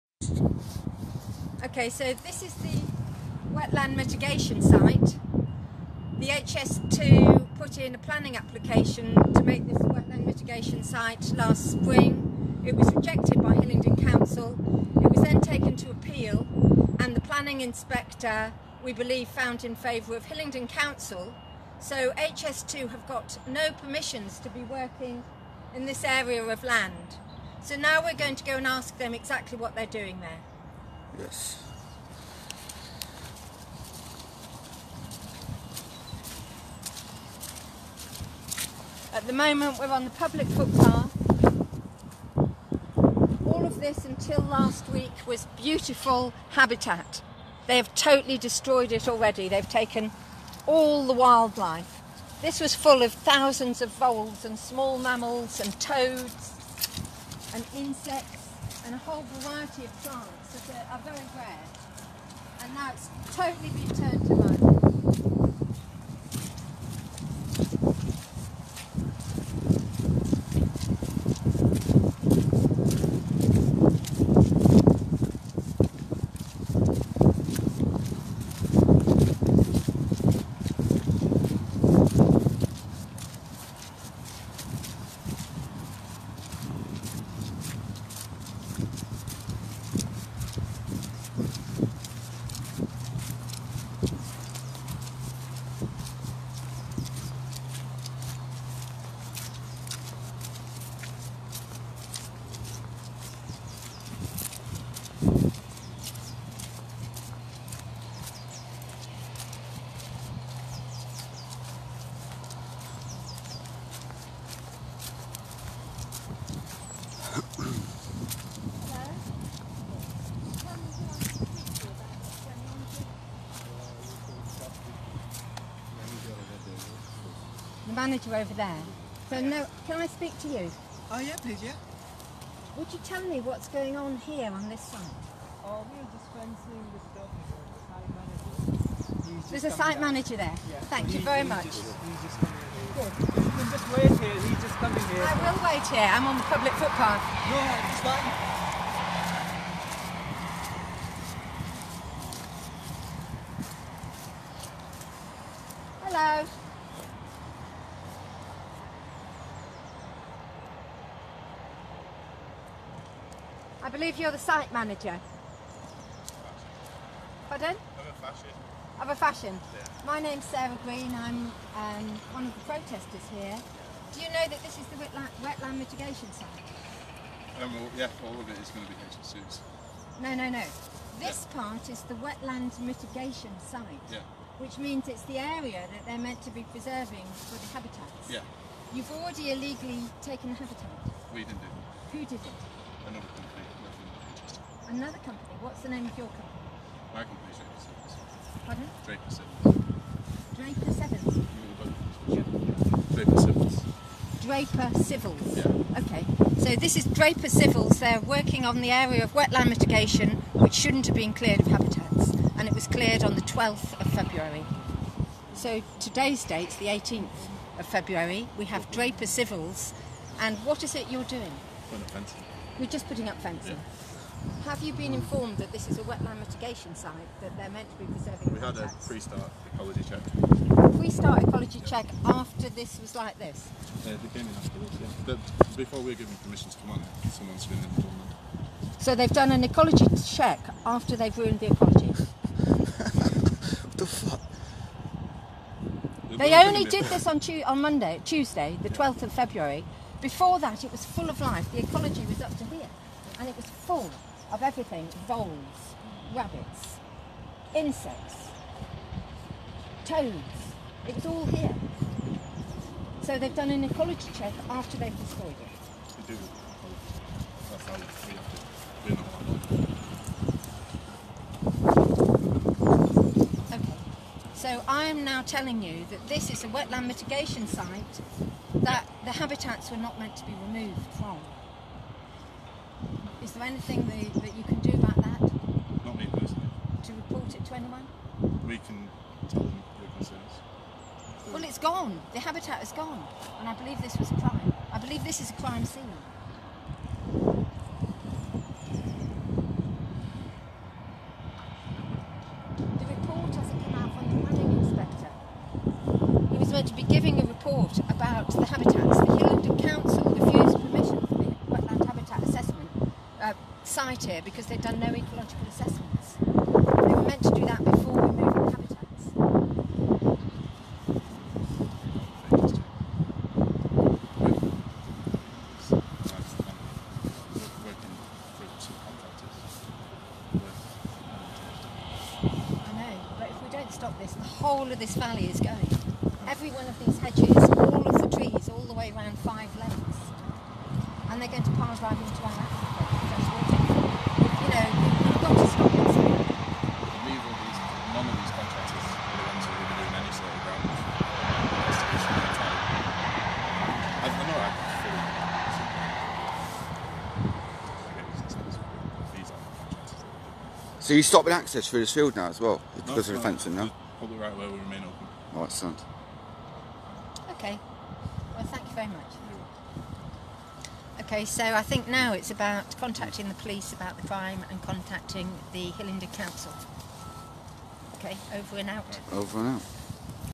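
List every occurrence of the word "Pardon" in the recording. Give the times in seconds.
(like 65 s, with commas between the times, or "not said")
167 s, 199 s.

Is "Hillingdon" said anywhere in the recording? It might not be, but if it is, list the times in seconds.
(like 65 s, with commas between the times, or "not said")
13 s, 20 s, 375 s.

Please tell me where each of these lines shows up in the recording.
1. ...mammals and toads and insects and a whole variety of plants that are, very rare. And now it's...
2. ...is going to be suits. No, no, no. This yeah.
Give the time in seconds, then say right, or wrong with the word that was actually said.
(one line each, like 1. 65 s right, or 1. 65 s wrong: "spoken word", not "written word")
1. 54 s right
2. 178 s right.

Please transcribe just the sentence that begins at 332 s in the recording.
I know, but if we don't stop this, the whole of this valley is going.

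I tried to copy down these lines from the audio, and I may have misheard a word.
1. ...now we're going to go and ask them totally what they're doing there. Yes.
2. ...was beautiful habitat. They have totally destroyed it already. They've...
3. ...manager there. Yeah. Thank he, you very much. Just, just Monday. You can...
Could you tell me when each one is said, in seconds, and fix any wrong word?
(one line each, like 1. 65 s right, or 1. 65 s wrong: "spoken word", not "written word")
1. 27 s wrong: "exactly", not "totally"
2. 45 s right
3. 140 s wrong: "Good", not "Monday".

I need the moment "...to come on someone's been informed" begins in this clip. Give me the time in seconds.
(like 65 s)
236 s.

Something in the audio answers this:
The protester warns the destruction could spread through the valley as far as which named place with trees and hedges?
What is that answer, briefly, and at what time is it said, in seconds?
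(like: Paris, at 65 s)
Five Lanes, at 339 s.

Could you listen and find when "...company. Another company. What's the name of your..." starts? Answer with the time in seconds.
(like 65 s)
193 s.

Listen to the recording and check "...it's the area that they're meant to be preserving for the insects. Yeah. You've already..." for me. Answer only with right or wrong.
wrong.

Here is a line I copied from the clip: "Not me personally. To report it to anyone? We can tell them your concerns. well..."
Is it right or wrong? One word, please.
right.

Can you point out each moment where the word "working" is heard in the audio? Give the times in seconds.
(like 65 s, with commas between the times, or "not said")
24 s, 208 s.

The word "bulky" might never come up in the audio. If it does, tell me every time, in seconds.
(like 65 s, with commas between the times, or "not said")
not said.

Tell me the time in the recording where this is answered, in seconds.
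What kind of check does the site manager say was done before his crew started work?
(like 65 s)
229 s.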